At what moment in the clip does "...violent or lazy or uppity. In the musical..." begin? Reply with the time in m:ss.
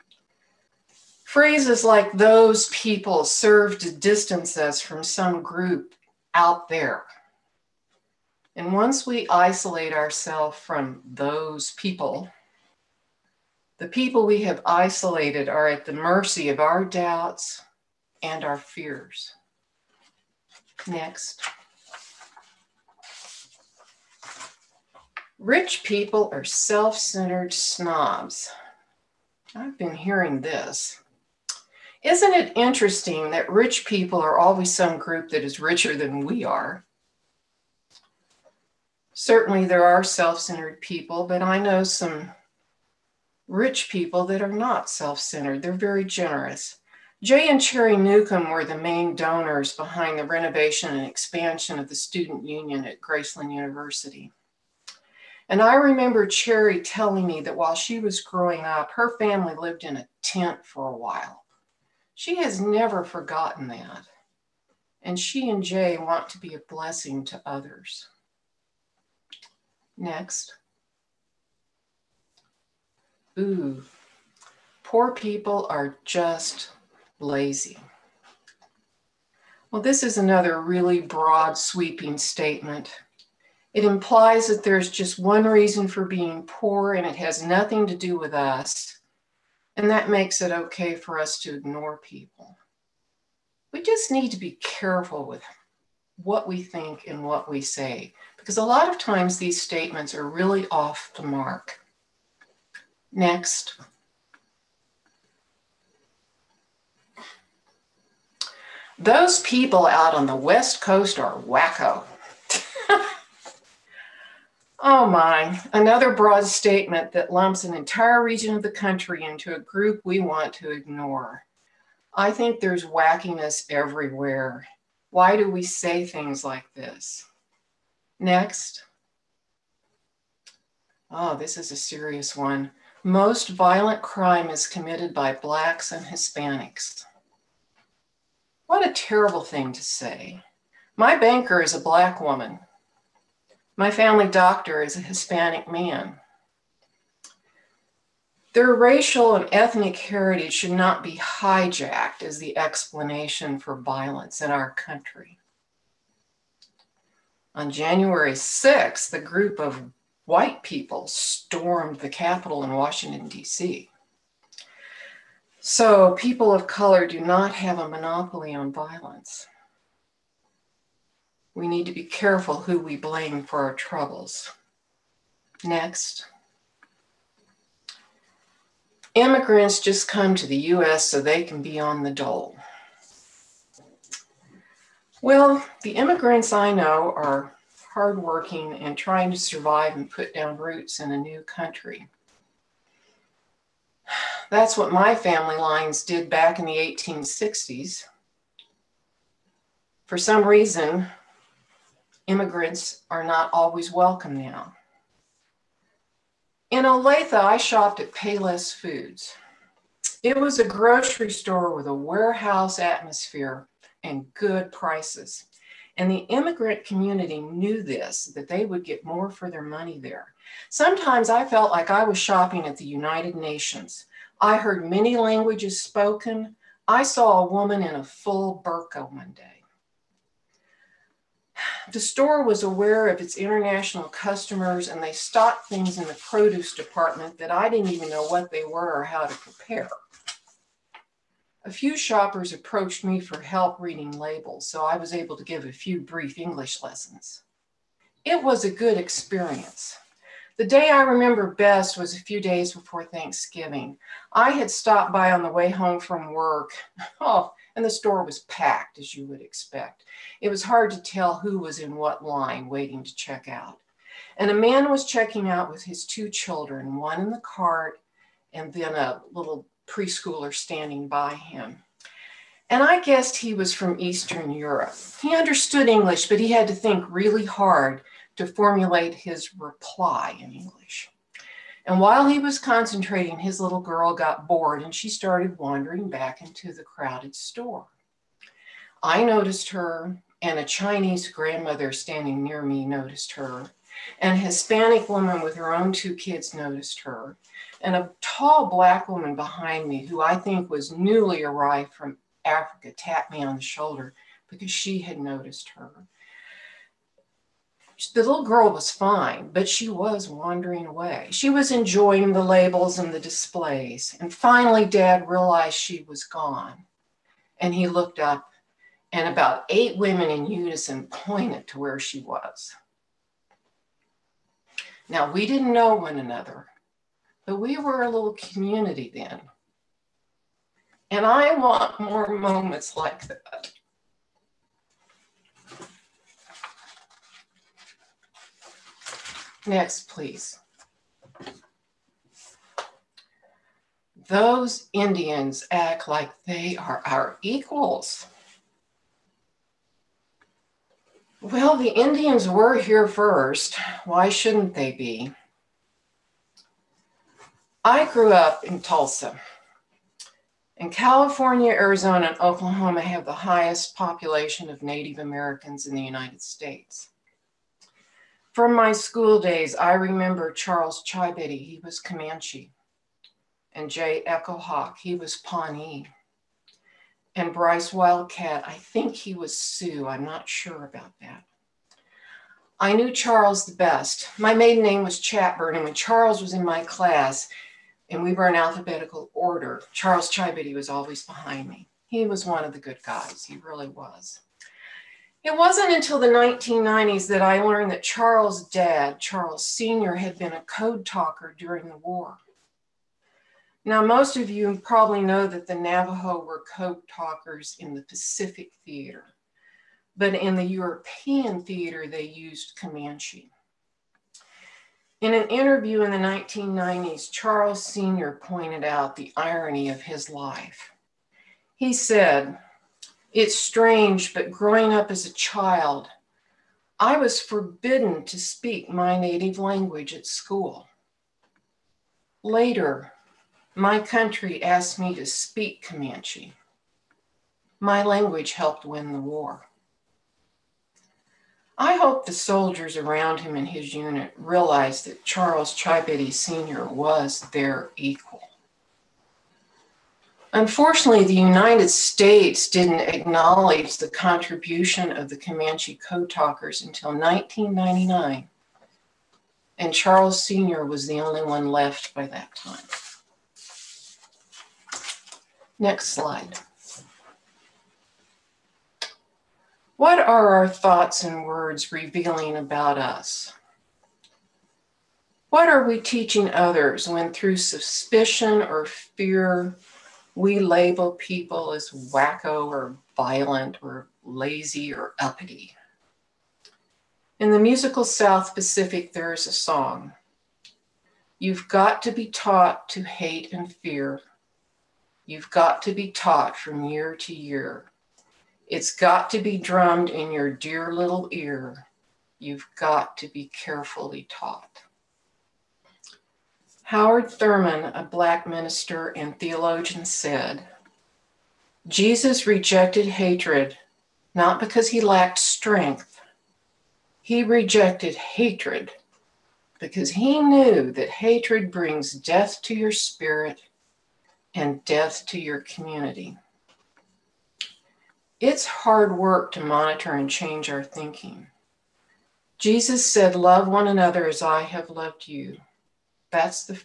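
8:03.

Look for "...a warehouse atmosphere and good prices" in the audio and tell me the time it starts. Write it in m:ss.
3:31.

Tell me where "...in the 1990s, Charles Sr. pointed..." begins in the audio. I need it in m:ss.
6:56.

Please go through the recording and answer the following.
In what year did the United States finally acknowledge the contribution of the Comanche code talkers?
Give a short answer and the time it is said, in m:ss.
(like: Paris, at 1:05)
1999, at 7:37.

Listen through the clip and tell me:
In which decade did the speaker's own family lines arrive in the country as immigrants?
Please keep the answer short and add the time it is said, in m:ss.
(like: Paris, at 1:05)
1860s, at 3:16.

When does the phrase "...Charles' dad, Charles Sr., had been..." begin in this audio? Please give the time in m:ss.
6:38.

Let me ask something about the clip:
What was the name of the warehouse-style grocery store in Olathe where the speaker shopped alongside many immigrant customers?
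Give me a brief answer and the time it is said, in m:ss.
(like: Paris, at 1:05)
Payless Foods, at 3:28.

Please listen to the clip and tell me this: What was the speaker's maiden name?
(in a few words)
Chatburn.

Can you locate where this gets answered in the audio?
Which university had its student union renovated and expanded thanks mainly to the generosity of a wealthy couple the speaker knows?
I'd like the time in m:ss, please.
0:53.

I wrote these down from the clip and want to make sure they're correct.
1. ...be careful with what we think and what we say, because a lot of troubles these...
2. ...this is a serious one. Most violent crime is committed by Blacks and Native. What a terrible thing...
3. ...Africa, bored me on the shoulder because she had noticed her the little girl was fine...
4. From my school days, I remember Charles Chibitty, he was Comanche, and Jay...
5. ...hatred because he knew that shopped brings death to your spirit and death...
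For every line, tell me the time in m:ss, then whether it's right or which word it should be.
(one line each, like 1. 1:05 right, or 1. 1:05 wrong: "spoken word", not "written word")
1. 1:34 wrong: "times", not "troubles"
2. 2:11 wrong: "Hispanics", not "Native"
3. 5:02 wrong: "tapped", not "bored"
4. 6:08 right
5. 8:38 wrong: "hatred", not "shopped".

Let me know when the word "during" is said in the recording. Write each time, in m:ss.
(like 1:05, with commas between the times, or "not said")
6:41.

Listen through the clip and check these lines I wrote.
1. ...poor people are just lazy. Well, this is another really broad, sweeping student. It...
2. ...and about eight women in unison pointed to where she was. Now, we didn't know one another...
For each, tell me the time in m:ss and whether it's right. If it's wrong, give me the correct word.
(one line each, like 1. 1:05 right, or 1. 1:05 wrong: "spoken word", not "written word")
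1. 1:14 wrong: "statement", not "student"
2. 5:19 right.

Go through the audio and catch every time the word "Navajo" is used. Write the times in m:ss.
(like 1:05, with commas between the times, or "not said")
6:45.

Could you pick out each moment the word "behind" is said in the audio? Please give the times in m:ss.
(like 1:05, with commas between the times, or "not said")
0:49, 4:59, 6:31.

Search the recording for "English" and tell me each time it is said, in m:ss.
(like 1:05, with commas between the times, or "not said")
4:06, 4:35, 4:40.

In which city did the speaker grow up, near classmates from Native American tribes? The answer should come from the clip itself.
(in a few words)
Tulsa.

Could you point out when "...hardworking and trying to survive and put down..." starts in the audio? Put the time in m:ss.
3:07.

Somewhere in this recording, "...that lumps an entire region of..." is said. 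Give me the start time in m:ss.
1:57.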